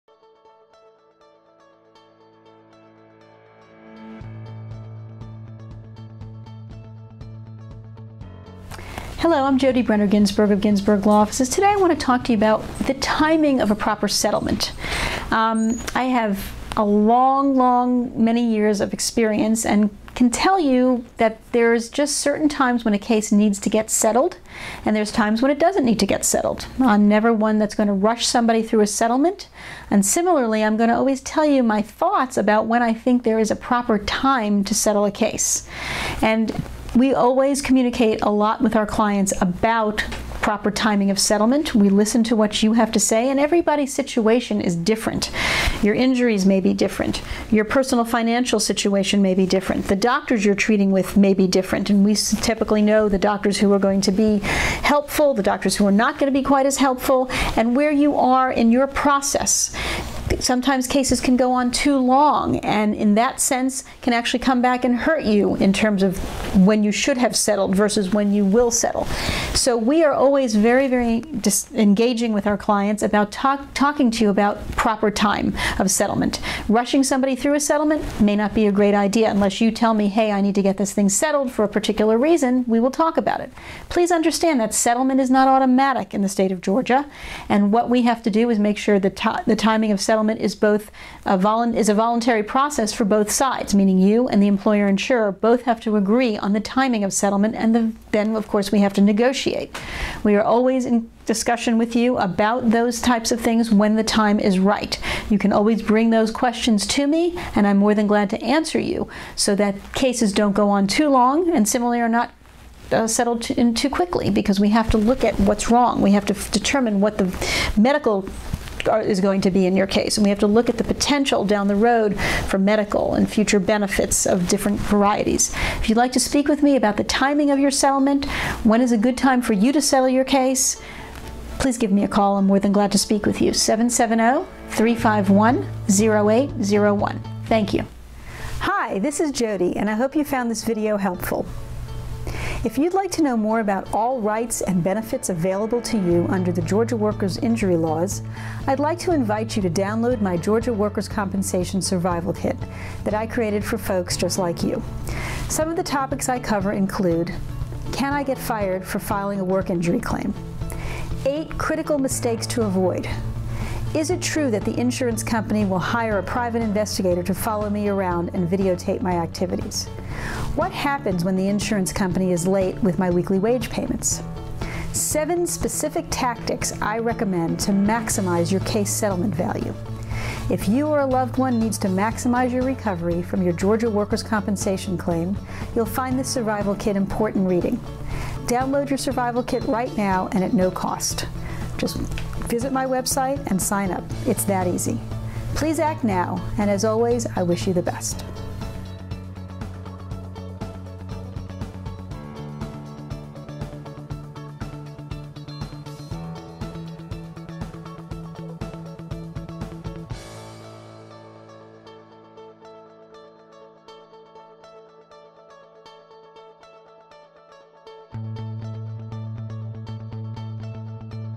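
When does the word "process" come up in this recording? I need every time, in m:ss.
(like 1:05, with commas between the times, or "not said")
0:58, 1:32.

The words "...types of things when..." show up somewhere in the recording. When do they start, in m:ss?
1:43.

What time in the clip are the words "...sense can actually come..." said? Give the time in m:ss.
1:03.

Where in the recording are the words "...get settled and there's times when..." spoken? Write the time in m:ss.
0:23.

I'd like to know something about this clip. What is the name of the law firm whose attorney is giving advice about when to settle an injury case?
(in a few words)
Ginsberg Law Offices.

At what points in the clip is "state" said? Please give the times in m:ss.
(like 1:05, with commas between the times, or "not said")
1:26.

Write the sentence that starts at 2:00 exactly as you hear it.
And we have to look at the potential down the road for medical and future benefits of different varieties.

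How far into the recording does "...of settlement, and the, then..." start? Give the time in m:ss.
1:37.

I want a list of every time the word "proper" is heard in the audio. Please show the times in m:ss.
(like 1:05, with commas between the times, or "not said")
0:13, 0:33, 0:40, 1:14.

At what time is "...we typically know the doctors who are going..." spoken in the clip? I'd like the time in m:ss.
0:52.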